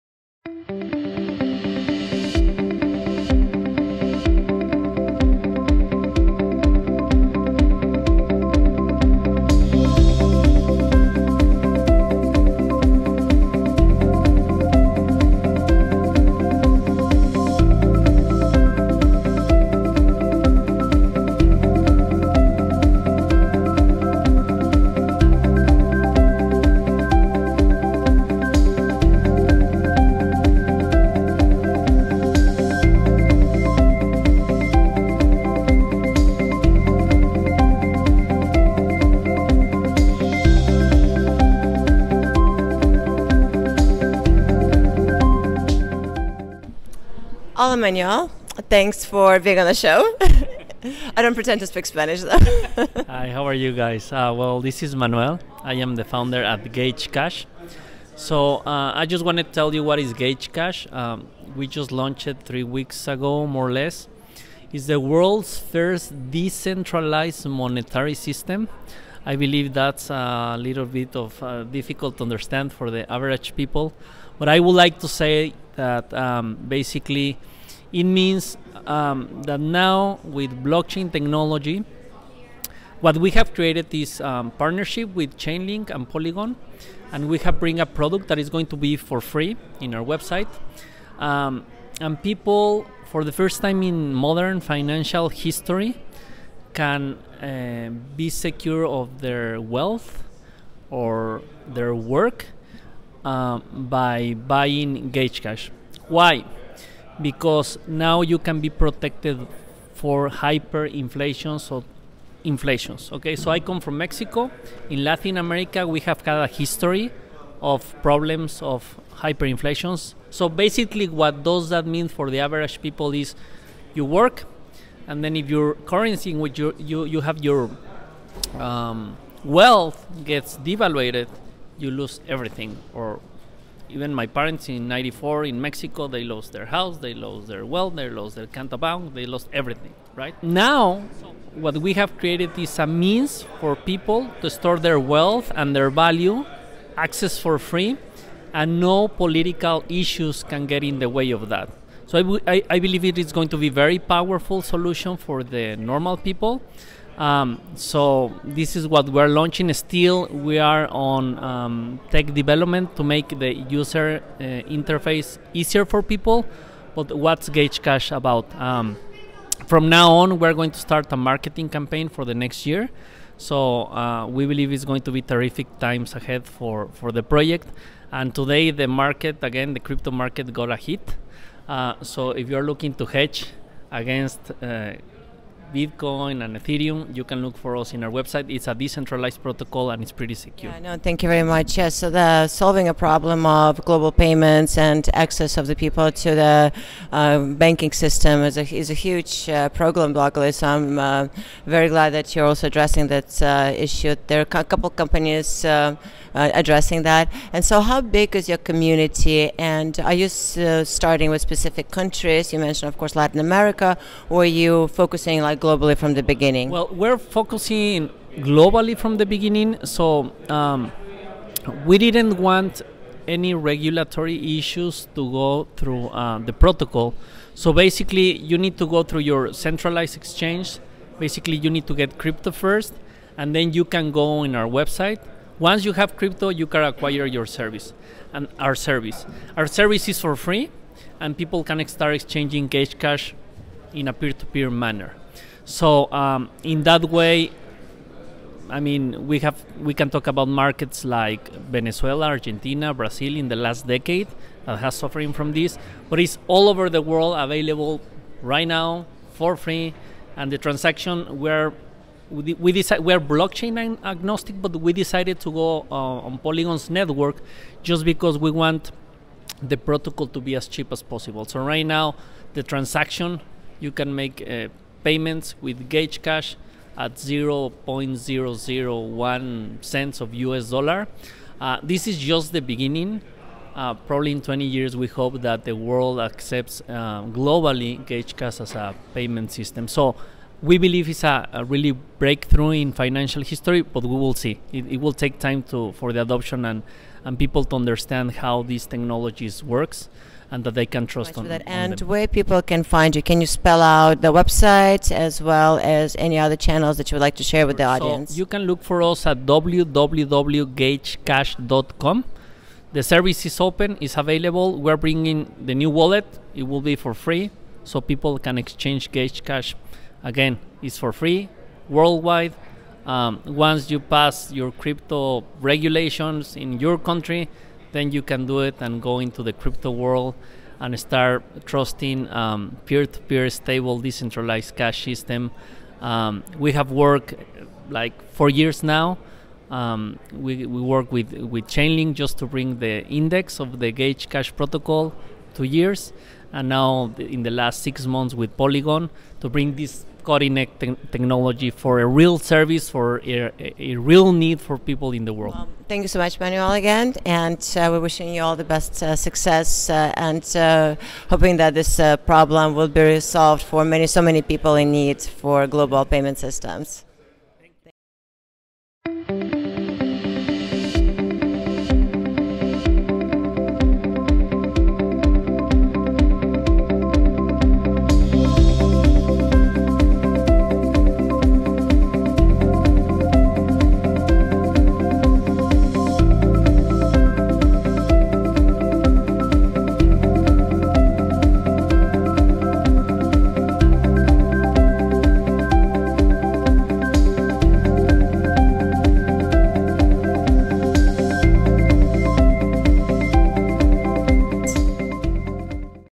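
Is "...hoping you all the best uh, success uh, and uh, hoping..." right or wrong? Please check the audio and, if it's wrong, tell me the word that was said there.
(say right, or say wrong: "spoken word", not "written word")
wrong: "wishing", not "hoping".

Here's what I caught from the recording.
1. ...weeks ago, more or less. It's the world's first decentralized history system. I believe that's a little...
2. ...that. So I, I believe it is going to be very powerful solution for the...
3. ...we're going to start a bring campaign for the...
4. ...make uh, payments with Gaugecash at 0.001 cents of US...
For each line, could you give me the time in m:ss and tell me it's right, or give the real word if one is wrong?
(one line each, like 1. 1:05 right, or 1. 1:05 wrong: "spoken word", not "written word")
1. 1:02 wrong: "monetary", not "history"
2. 2:31 right
3. 2:50 wrong: "marketing", not "bring"
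4. 4:34 right.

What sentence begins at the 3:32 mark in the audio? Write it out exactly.
You mentioned, of course, Latin America.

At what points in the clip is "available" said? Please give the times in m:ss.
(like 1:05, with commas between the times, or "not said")
4:17, 5:14.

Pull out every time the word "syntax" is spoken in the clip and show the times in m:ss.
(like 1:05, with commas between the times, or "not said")
not said.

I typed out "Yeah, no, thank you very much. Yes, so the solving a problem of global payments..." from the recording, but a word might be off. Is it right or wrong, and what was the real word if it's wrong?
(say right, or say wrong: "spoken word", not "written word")
right.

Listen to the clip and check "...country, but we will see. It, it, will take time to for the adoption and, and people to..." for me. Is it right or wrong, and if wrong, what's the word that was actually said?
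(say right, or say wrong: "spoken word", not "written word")
wrong: "history", not "country".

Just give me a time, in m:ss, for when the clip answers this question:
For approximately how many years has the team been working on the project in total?
5:38.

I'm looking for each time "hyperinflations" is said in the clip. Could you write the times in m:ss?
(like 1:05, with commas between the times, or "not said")
1:50, 1:59.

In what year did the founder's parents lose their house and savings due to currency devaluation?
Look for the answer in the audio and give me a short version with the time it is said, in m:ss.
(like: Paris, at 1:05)
1994, at 2:14.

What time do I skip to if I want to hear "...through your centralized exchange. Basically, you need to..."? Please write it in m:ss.
3:49.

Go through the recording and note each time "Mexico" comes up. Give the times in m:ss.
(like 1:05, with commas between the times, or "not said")
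1:53, 2:15.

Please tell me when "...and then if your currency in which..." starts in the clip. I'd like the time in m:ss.
2:05.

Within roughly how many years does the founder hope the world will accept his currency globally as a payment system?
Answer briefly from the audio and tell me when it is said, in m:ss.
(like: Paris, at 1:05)
20 years, at 4:44.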